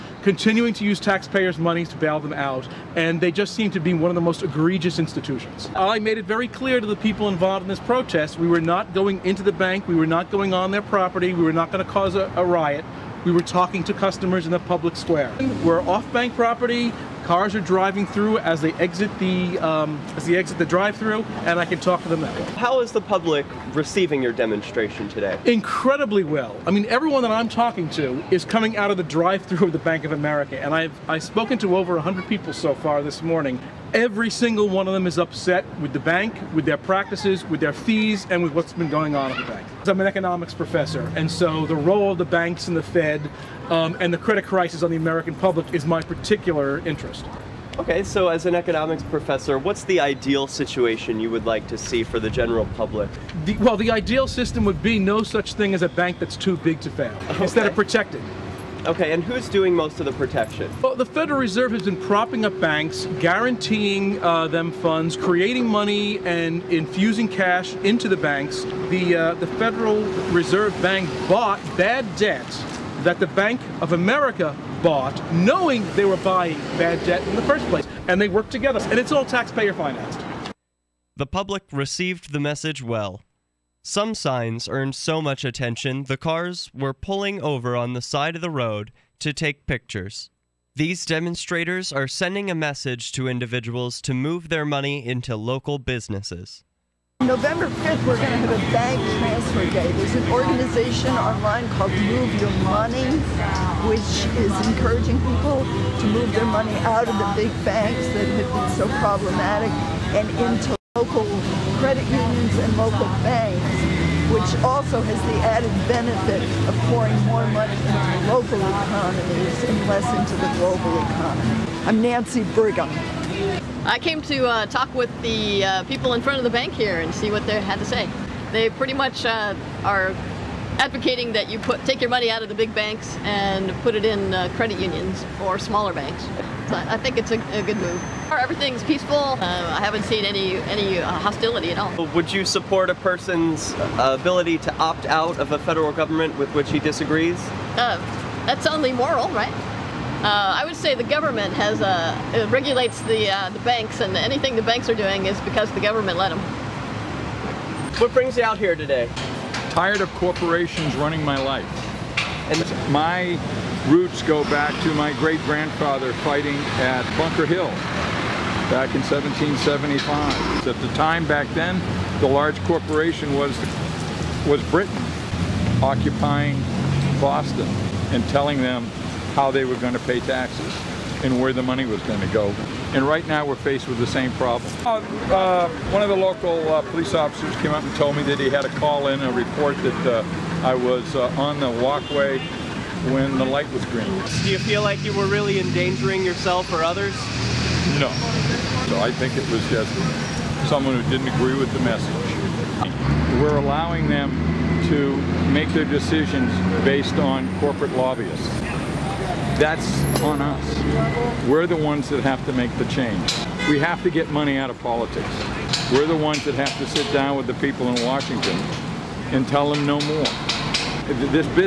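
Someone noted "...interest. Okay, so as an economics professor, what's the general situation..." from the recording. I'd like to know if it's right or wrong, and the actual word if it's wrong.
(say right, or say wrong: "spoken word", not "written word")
wrong: "ideal", not "general".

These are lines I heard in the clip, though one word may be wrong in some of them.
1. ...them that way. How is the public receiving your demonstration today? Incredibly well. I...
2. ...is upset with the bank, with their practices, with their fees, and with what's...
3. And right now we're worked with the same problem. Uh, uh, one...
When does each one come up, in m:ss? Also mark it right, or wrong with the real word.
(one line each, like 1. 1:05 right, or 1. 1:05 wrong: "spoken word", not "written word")
1. 0:22 right
2. 0:35 right
3. 3:02 wrong: "faced", not "worked".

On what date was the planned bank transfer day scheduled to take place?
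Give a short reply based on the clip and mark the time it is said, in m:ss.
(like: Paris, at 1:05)
November 5th, at 1:37.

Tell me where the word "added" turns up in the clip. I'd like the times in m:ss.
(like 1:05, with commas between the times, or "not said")
1:55.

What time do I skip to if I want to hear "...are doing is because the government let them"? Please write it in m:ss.
2:34.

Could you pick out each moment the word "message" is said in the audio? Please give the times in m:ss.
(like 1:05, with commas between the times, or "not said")
1:22, 1:32, 3:21.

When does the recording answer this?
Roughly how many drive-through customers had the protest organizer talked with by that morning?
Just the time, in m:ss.
0:31.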